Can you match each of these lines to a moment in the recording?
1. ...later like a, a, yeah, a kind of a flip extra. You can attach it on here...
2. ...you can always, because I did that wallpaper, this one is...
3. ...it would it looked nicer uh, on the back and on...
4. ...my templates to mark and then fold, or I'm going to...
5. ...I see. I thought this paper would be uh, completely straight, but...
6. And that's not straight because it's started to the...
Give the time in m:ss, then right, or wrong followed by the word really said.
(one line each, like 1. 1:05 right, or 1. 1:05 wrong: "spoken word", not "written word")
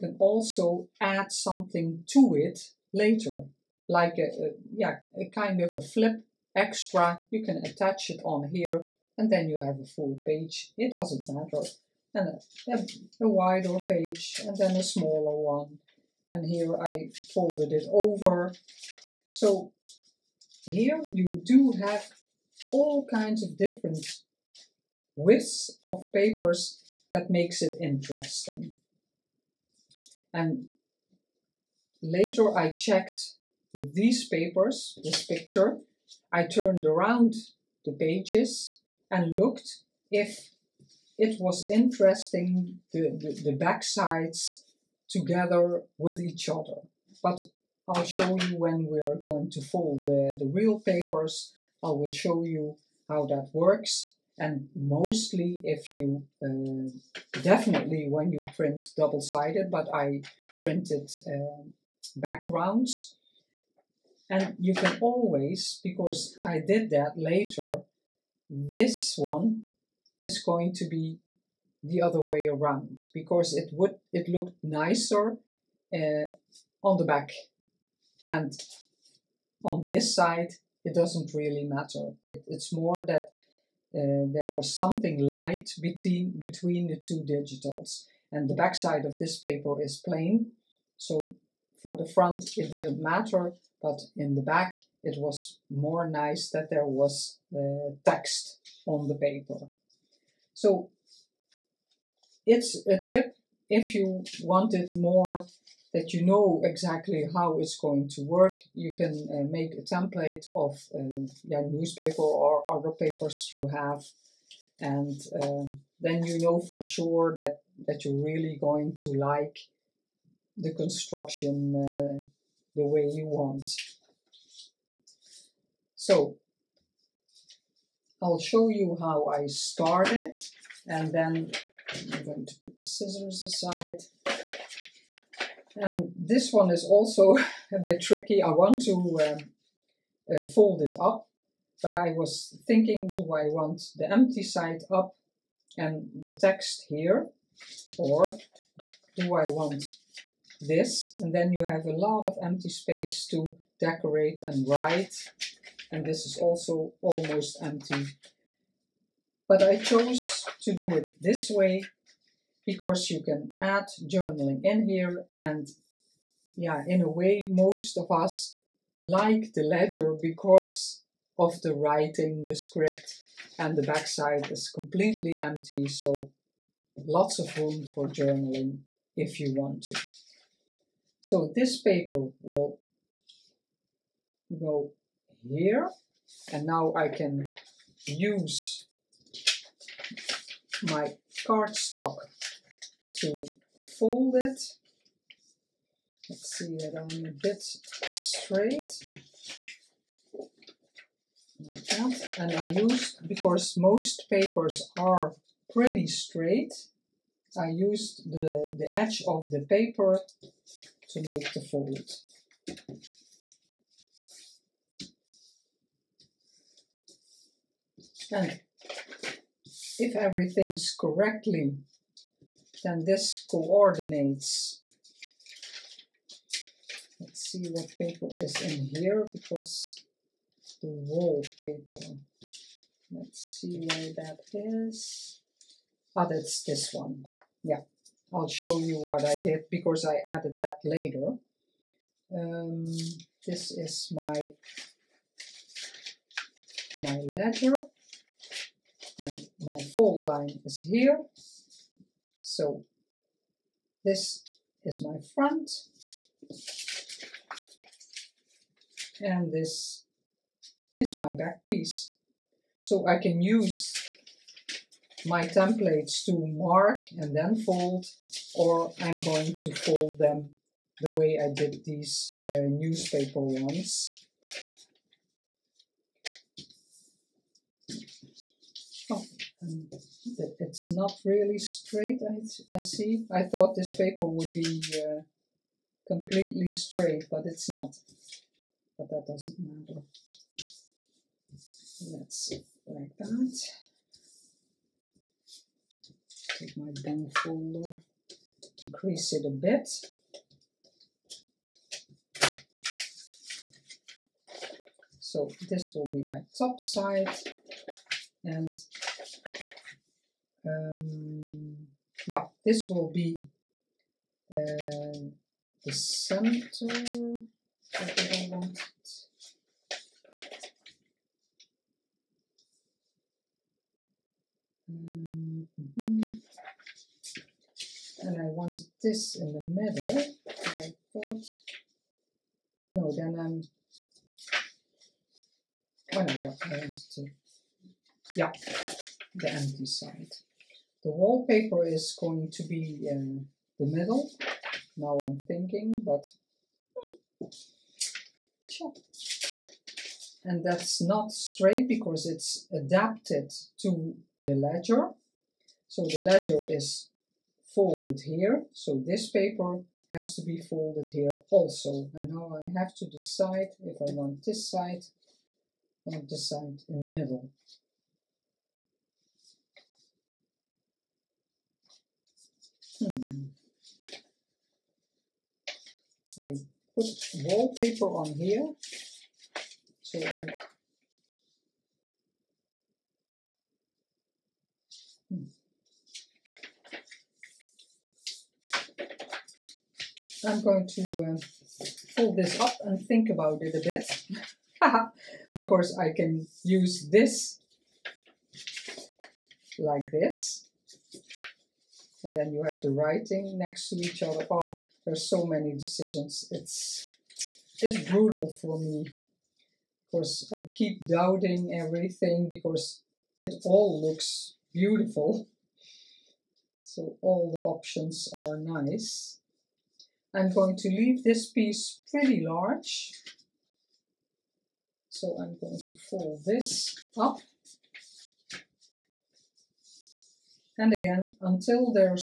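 1. 0:02 right
2. 1:04 wrong: "later", not "wallpaper"
3. 1:13 right
4. 4:25 right
5. 4:42 right
6. 5:50 wrong: "adapted", not "started".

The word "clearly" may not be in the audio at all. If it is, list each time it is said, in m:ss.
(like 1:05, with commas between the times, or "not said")
not said.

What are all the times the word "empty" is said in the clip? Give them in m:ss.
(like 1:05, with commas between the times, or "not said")
2:24, 2:32, 2:37, 2:55, 5:39.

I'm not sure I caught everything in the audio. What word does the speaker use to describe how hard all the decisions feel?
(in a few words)
Brutal.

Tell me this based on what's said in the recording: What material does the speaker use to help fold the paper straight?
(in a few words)
Cardstock.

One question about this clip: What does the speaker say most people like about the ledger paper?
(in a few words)
The writing, the script.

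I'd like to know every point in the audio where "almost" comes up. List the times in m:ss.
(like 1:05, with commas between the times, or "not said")
2:37.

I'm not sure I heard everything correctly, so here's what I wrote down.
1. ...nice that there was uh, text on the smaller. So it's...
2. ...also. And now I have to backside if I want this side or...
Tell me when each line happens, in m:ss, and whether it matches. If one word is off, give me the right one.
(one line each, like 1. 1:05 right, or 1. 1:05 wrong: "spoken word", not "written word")
1. 1:36 wrong: "paper", not "smaller"
2. 6:01 wrong: "decide", not "backside".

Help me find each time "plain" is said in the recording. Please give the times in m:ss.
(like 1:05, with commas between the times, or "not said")
1:30.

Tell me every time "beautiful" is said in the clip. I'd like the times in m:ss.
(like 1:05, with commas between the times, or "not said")
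6:54.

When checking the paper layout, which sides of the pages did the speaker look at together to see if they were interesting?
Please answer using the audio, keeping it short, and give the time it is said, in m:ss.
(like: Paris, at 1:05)
The back sides, at 0:43.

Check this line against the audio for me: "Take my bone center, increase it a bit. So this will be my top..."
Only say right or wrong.
wrong.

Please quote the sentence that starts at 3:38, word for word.
And if everything's correctly, then this coordinates.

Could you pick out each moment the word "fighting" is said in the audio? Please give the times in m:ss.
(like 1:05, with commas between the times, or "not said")
not said.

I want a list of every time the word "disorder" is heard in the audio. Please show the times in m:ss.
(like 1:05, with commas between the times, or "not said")
not said.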